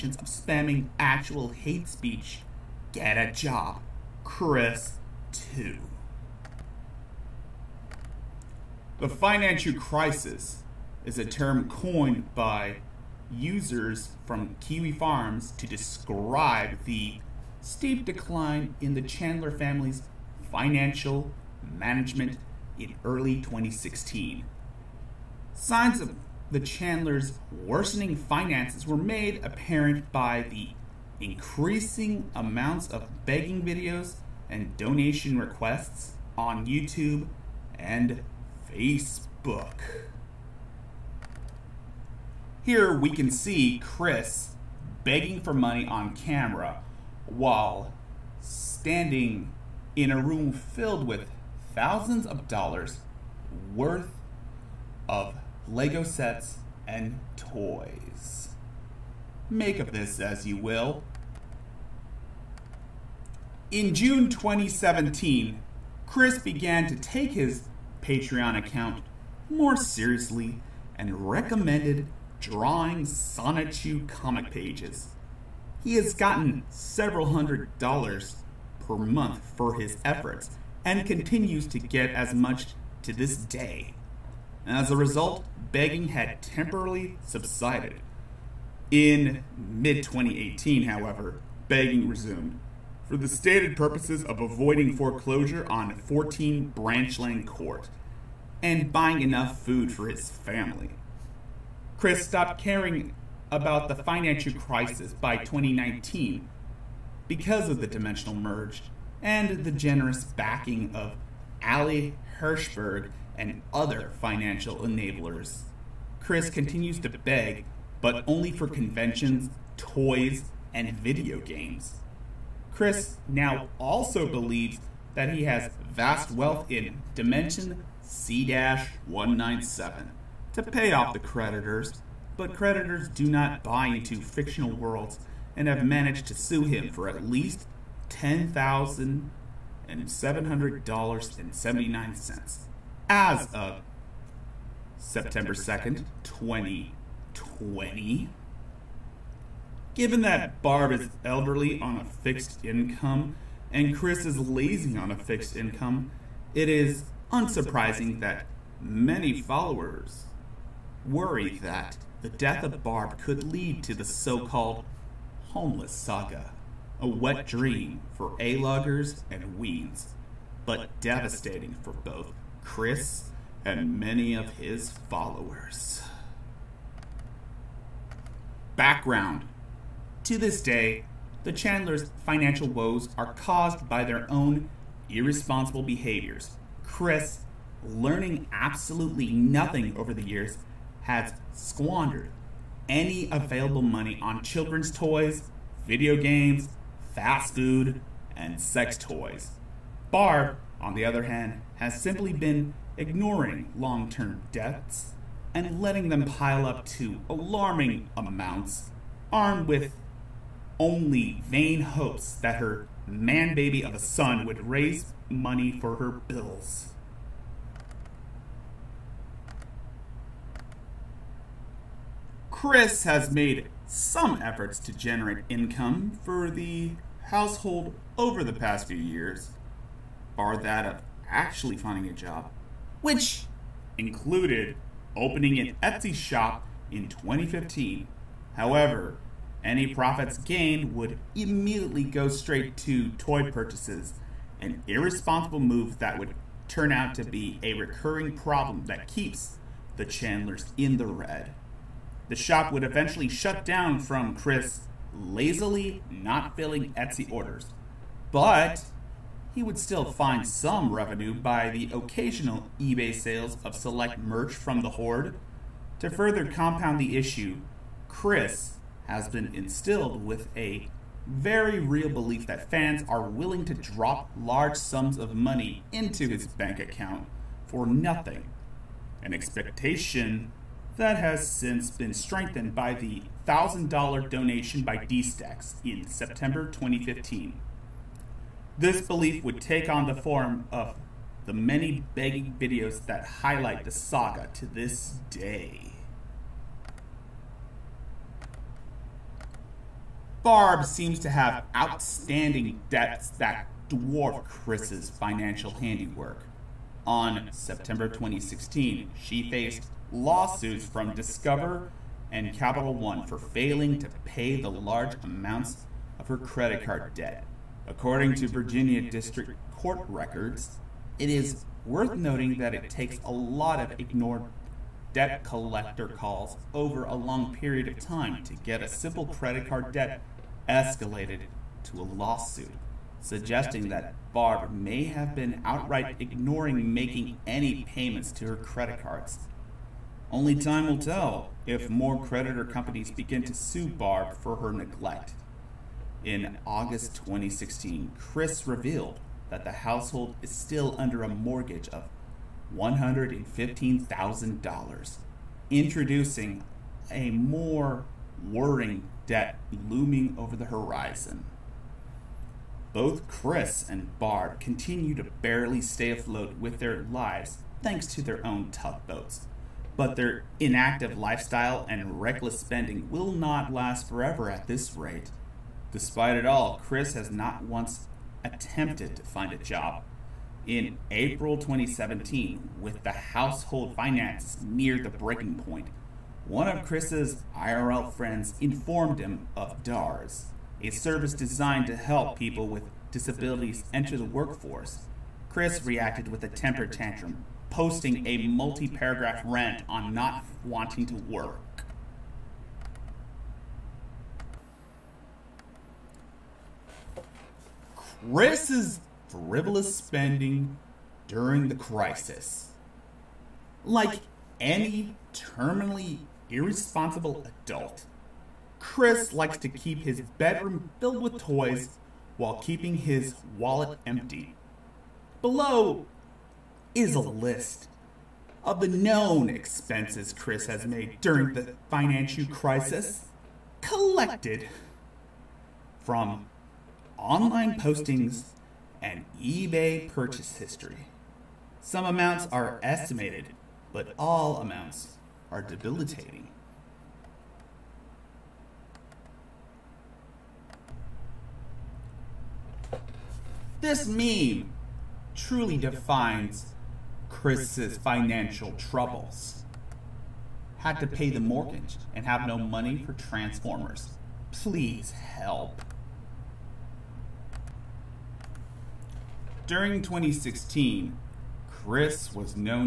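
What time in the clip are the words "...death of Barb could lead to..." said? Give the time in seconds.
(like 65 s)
162 s.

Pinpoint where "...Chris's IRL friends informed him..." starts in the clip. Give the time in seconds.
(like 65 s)
386 s.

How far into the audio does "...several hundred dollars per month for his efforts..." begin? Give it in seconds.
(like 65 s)
76 s.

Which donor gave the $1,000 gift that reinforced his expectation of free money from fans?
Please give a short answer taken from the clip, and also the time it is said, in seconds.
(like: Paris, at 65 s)
DSTAX, at 284 s.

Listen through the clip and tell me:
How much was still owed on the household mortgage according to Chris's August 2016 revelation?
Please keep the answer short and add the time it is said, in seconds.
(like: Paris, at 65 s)
$115,000, at 352 s.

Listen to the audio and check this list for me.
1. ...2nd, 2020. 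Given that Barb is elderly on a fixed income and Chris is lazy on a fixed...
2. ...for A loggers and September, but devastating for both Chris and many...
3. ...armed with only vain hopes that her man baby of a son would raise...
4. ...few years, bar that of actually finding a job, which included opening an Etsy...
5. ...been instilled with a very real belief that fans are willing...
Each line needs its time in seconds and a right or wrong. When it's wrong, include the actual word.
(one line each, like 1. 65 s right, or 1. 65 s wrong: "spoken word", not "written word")
1. 145 s right
2. 168 s wrong: "Weens", not "September"
3. 209 s right
4. 228 s right
5. 269 s right.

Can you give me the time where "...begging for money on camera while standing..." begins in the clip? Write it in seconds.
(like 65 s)
45 s.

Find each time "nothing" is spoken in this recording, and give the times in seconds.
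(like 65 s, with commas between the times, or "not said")
189 s, 277 s.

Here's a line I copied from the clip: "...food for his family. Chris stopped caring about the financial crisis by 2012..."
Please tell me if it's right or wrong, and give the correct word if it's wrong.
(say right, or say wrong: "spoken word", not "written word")
wrong: "2019", not "2012".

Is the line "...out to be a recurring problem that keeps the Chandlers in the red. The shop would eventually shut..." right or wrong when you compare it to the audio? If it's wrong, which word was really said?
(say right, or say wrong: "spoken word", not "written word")
right.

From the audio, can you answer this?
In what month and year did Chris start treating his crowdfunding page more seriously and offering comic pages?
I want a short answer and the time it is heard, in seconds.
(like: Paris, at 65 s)
June 2017, at 63 s.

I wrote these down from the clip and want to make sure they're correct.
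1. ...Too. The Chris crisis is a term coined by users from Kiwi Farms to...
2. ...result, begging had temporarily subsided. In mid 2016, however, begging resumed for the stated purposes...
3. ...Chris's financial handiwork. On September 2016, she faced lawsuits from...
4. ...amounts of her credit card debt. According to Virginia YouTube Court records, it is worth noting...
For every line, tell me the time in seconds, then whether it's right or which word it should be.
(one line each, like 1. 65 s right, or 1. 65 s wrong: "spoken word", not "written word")
1. 5 s wrong: "Financhu", not "Chris"
2. 84 s wrong: "2018", not "2016"
3. 304 s right
4. 315 s wrong: "District", not "YouTube".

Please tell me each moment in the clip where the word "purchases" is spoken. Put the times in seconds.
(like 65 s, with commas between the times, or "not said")
243 s, 440 s.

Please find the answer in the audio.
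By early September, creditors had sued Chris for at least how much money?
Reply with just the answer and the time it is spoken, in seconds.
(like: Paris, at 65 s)
$10,700.79, at 138 s.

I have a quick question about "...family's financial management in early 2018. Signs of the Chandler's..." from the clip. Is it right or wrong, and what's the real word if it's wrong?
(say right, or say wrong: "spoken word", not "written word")
wrong: "2016", not "2018".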